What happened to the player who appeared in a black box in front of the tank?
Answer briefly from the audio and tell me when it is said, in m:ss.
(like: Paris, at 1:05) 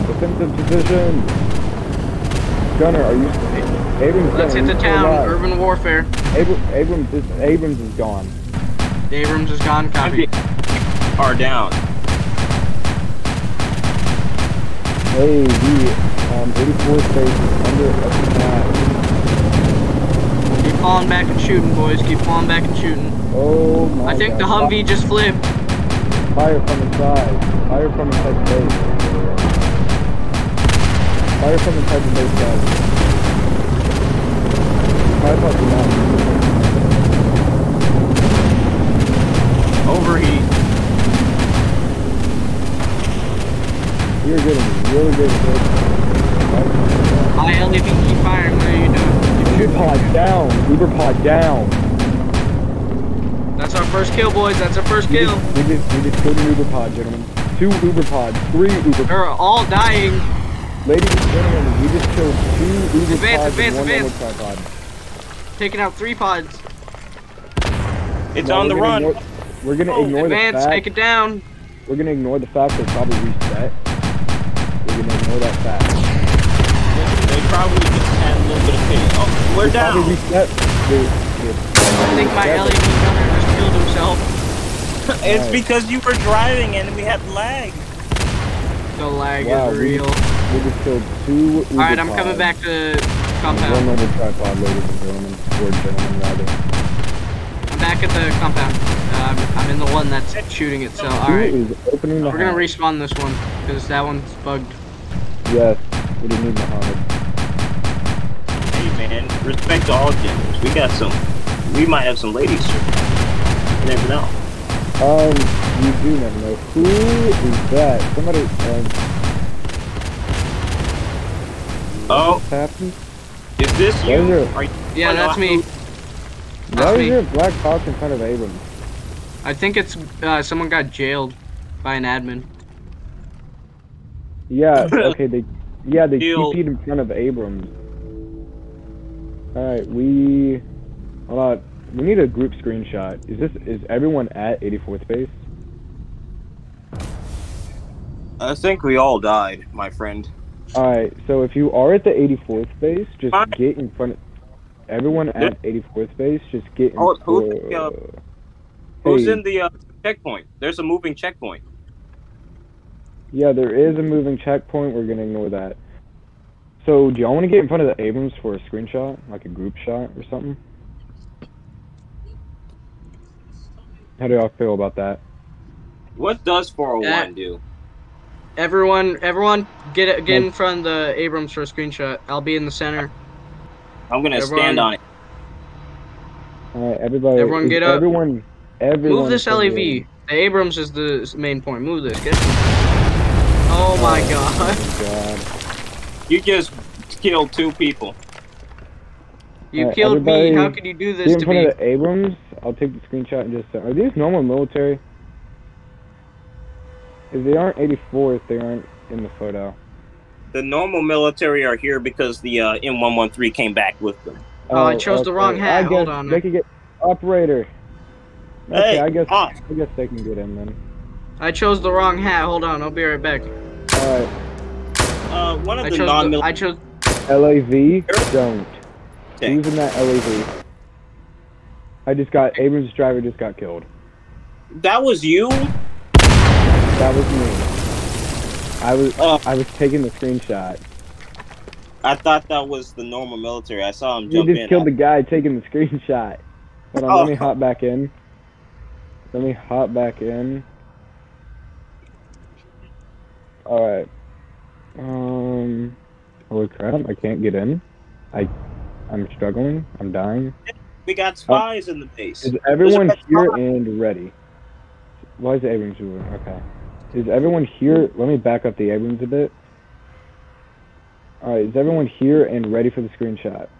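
Jailed by an admin, at 2:10.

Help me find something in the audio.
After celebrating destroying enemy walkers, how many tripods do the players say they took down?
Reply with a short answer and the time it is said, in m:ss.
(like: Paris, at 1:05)
1, at 1:33.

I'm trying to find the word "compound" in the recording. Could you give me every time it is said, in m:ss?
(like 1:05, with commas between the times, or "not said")
1:33, 1:38.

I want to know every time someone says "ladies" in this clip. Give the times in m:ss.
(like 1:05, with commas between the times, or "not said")
1:00, 1:34, 1:52.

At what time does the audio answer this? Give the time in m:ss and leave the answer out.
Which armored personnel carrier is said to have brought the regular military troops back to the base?
3:32.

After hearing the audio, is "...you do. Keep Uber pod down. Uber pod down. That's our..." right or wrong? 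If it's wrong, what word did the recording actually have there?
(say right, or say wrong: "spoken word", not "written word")
right.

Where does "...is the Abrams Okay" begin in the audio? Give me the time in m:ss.
4:25.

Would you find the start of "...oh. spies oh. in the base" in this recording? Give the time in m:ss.
4:21.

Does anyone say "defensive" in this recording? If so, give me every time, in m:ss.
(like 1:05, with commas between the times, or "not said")
0:00.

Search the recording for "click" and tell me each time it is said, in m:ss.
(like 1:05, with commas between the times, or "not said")
not said.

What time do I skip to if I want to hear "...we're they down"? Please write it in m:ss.
1:19.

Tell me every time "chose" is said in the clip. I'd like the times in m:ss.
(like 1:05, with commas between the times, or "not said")
3:34, 3:41, 3:46.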